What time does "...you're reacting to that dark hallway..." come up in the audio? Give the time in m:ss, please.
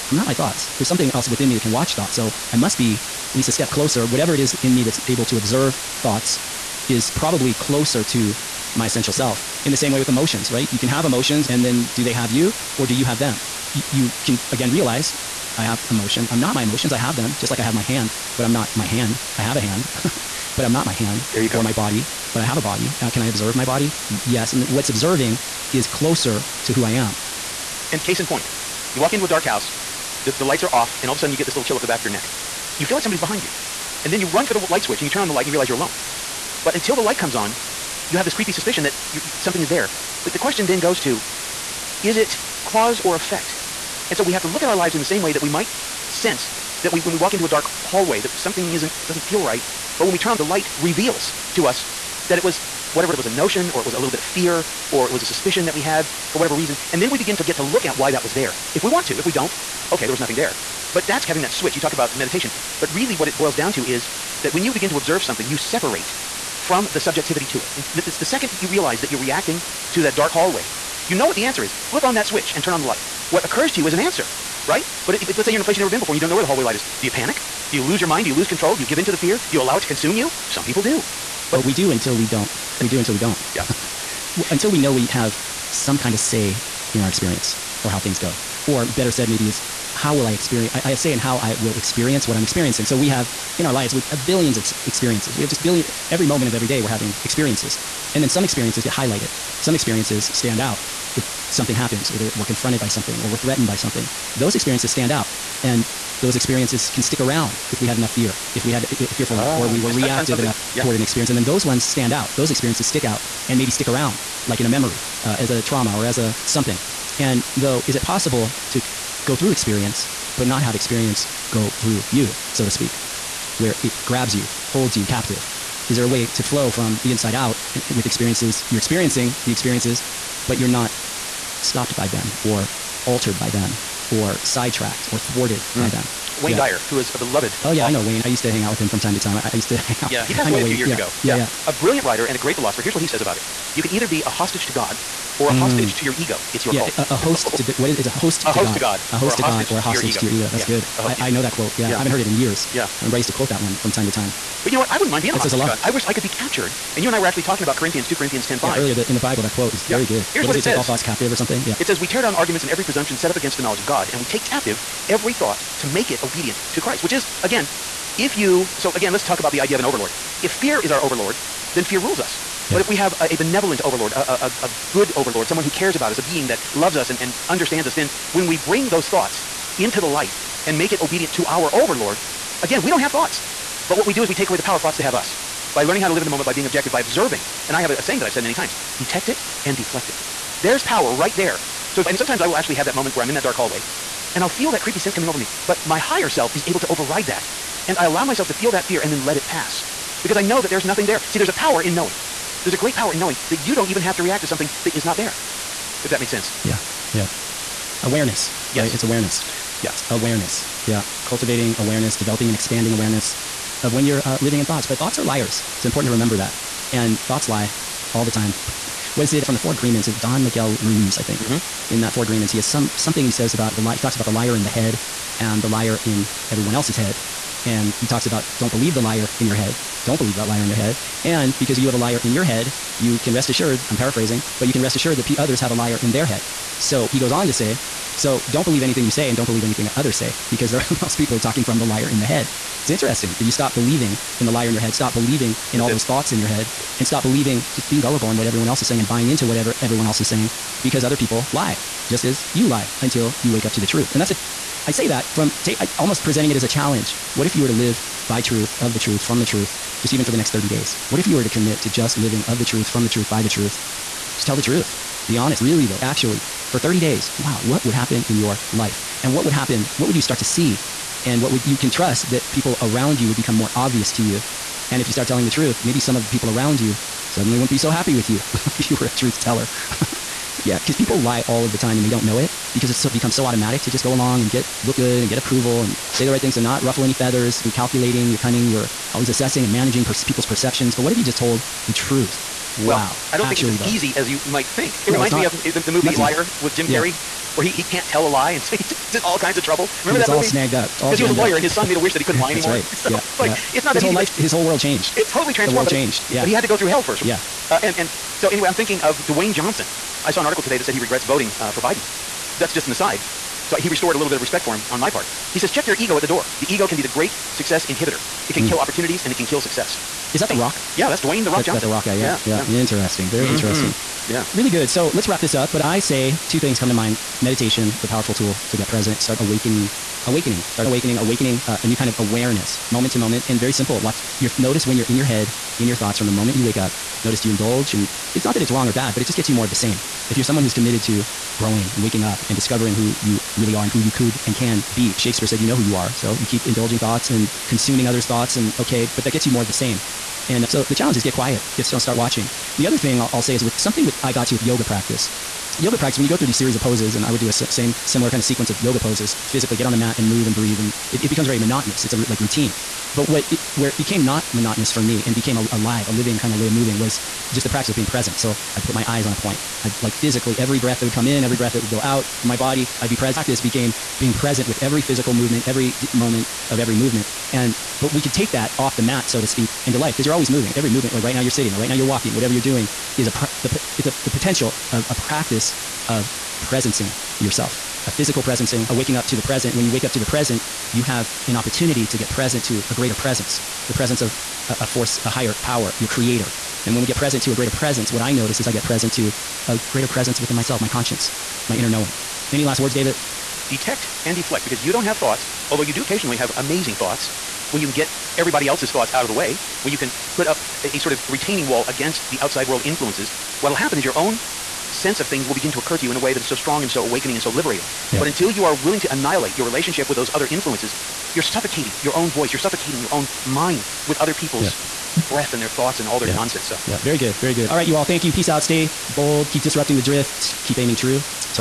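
1:09.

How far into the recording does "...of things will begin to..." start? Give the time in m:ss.
6:55.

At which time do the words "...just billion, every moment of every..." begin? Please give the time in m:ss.
1:35.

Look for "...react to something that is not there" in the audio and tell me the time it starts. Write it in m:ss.
3:24.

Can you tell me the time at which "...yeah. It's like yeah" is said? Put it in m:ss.
5:03.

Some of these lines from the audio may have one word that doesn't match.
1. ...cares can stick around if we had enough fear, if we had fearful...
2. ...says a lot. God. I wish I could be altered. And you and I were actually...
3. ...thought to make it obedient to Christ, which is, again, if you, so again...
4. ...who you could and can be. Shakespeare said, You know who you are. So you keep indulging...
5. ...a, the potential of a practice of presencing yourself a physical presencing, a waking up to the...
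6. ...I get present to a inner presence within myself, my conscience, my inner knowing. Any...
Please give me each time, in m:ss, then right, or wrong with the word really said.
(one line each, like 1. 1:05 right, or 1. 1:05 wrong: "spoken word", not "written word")
1. 1:46 wrong: "experiences", not "cares"
2. 2:35 wrong: "captured", not "altered"
3. 2:45 right
4. 5:43 right
5. 6:24 right
6. 6:38 wrong: "greater", not "inner".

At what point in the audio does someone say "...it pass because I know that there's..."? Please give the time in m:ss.
3:19.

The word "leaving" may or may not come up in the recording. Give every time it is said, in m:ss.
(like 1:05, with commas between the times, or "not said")
not said.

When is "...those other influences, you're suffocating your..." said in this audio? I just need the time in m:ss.
7:00.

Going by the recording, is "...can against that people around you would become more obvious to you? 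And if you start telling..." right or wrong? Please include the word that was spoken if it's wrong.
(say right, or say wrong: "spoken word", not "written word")
wrong: "trust", not "against".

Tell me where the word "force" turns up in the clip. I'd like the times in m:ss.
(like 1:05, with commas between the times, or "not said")
6:34.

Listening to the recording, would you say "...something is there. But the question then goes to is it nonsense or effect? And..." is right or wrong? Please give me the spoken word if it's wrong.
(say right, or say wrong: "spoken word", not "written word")
wrong: "cause", not "nonsense".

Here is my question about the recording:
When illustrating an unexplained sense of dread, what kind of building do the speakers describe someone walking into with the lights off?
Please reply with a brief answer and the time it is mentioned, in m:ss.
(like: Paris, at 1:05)
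dark house, at 0:29.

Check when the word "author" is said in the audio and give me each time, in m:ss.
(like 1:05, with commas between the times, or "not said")
2:17.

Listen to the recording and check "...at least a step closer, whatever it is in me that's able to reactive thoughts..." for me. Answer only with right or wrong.
wrong.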